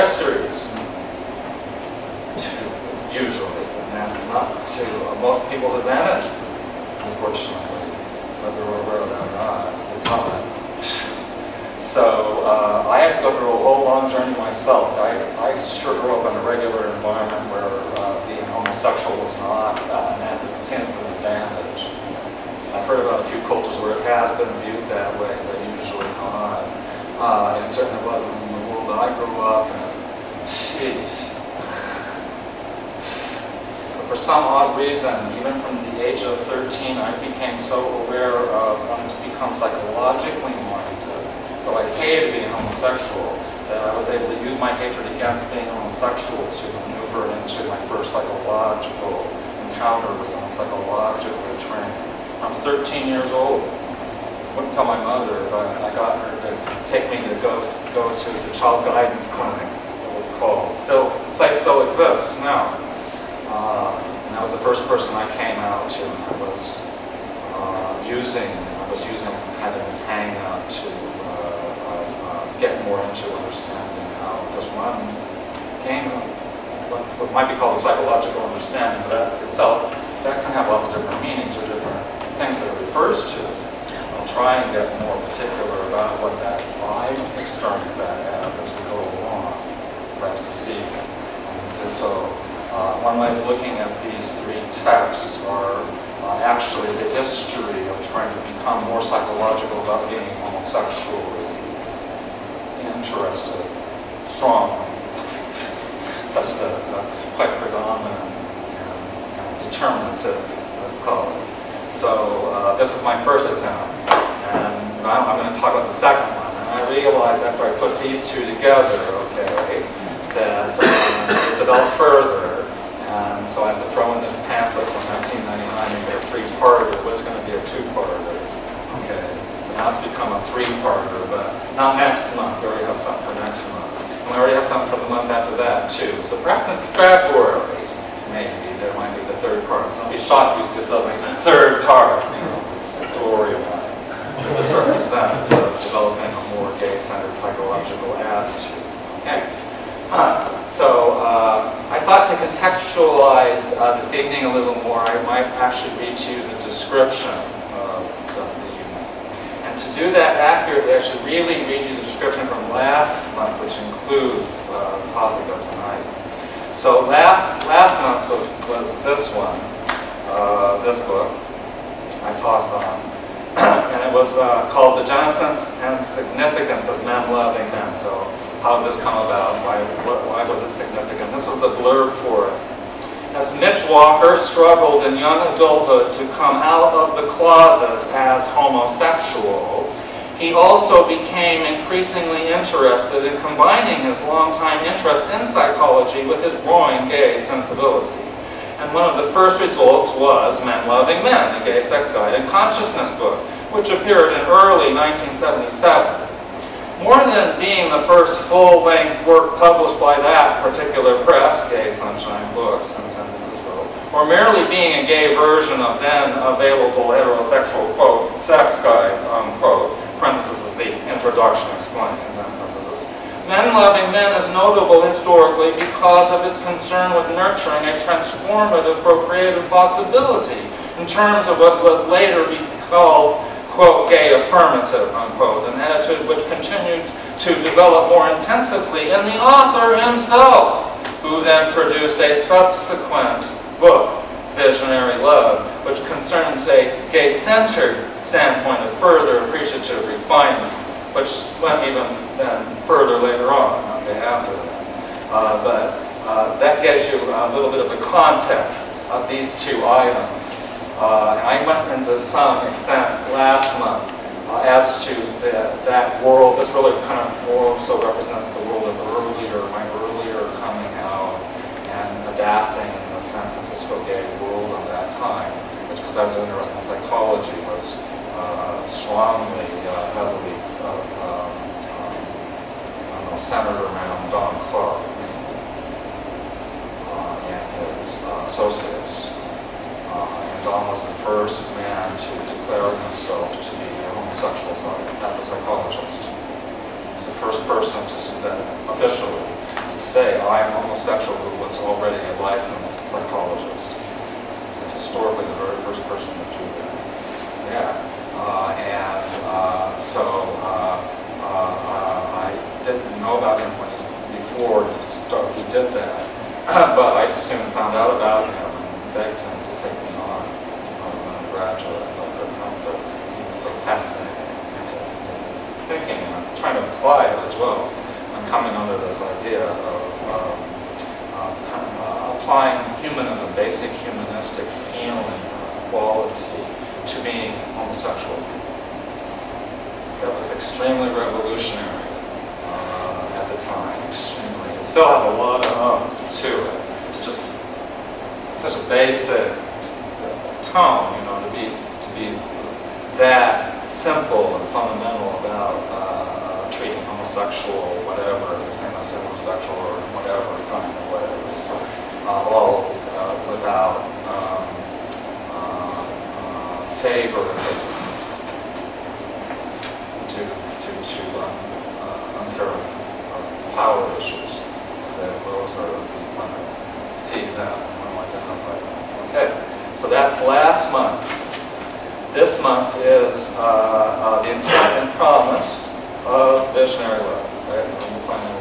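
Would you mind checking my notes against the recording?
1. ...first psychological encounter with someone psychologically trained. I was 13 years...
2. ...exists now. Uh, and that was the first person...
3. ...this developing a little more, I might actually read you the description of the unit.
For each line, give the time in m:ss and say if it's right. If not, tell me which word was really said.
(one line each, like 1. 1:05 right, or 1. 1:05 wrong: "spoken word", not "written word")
1. 0:47 right
2. 1:01 right
3. 2:33 wrong: "evening", not "developing".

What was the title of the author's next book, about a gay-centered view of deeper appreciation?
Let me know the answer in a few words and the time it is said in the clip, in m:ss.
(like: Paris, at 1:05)
Visionary Love, at 4:04.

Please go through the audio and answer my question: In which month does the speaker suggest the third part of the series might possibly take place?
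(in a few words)
February.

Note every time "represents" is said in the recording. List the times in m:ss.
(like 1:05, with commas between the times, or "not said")
2:24, 4:28.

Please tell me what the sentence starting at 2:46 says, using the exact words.
So last, last month was, was this one, uh, this book I talked on.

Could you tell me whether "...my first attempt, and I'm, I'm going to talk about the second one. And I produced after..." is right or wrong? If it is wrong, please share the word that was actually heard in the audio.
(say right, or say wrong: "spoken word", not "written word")
wrong: "realized", not "produced".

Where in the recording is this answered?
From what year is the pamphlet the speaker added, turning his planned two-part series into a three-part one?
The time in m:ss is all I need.
2:05.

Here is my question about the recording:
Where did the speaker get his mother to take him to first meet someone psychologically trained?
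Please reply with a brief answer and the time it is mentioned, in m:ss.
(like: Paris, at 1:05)
child guidance clinic, at 0:58.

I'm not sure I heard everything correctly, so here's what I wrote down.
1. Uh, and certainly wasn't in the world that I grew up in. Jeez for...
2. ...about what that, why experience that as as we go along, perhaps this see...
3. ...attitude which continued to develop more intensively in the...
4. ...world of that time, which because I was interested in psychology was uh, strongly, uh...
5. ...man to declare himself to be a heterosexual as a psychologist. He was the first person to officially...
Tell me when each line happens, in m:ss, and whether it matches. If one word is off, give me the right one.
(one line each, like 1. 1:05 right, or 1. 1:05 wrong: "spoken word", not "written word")
1. 0:27 right
2. 1:25 right
3. 3:55 right
4. 4:34 right
5. 4:51 wrong: "homosexual", not "heterosexual".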